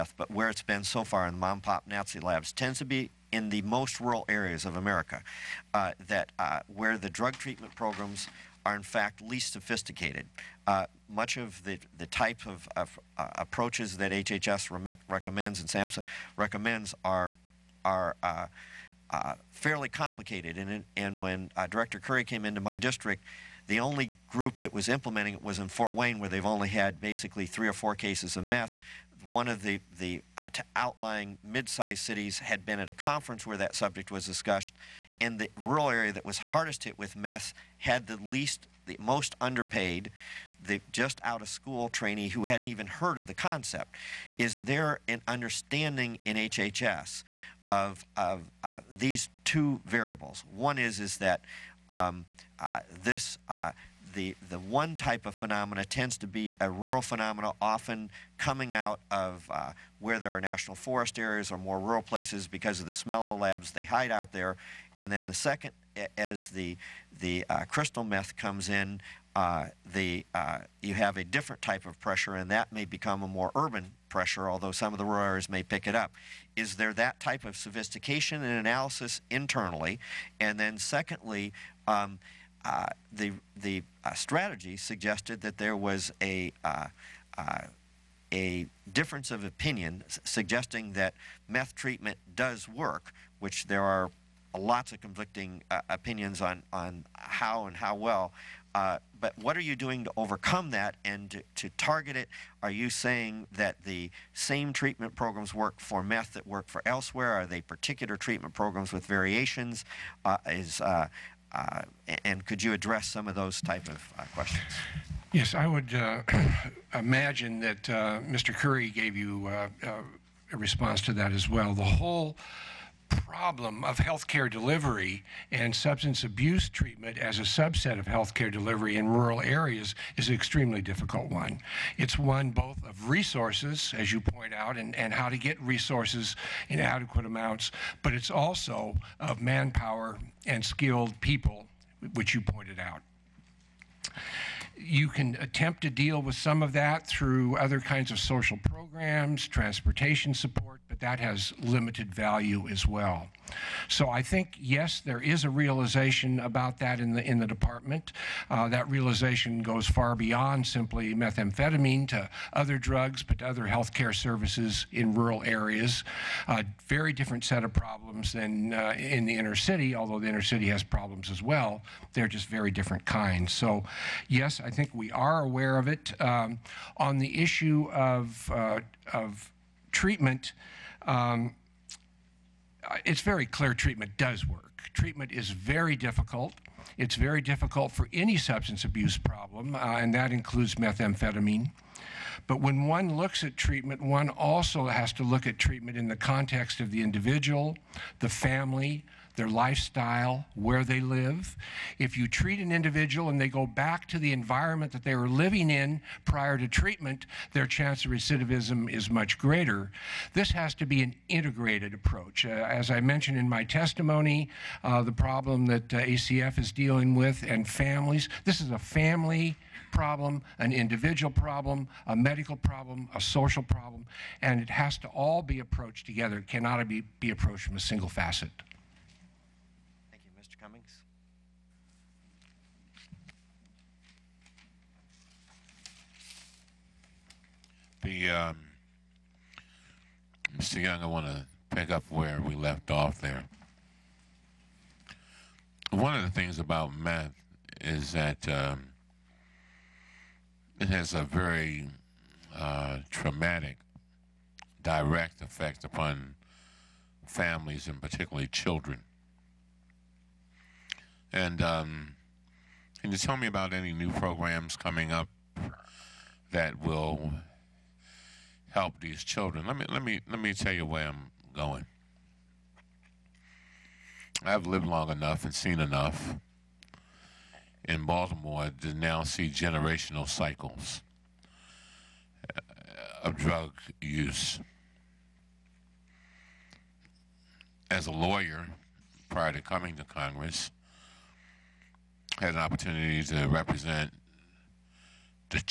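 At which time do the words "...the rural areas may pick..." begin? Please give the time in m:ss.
1:14.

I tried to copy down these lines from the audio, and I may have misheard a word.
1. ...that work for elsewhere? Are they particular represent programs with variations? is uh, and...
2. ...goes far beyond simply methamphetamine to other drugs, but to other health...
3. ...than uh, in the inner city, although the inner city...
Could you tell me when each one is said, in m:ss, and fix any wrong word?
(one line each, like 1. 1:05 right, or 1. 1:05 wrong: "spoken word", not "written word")
1. 1:46 wrong: "treatment", not "represent"
2. 2:39 right
3. 2:48 right.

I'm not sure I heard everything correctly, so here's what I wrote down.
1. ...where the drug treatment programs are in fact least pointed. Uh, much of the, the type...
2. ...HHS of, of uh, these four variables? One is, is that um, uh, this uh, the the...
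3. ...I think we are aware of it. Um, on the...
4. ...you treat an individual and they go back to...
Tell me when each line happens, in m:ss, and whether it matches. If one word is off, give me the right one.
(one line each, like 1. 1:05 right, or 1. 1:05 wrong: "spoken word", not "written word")
1. 0:06 wrong: "sophisticated", not "pointed"
2. 0:46 wrong: "two", not "four"
3. 2:54 right
4. 3:22 right.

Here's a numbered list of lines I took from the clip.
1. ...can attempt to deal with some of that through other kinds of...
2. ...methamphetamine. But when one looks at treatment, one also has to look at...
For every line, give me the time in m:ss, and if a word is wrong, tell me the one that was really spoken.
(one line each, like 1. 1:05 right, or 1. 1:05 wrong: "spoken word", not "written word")
1. 2:25 right
2. 3:10 right.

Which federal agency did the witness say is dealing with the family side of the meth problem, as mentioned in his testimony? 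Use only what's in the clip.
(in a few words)
ACF.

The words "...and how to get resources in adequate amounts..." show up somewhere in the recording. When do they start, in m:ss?
2:14.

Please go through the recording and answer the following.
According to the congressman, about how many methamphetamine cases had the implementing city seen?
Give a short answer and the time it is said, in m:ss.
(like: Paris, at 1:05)
3 or 4, at 0:27.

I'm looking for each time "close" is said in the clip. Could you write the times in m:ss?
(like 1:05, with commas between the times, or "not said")
not said.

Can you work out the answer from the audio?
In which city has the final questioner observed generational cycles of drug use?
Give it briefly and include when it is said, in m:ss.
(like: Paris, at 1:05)
Baltimore, at 4:38.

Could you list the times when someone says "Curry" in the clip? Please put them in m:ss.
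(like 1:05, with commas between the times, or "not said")
0:21, 1:58.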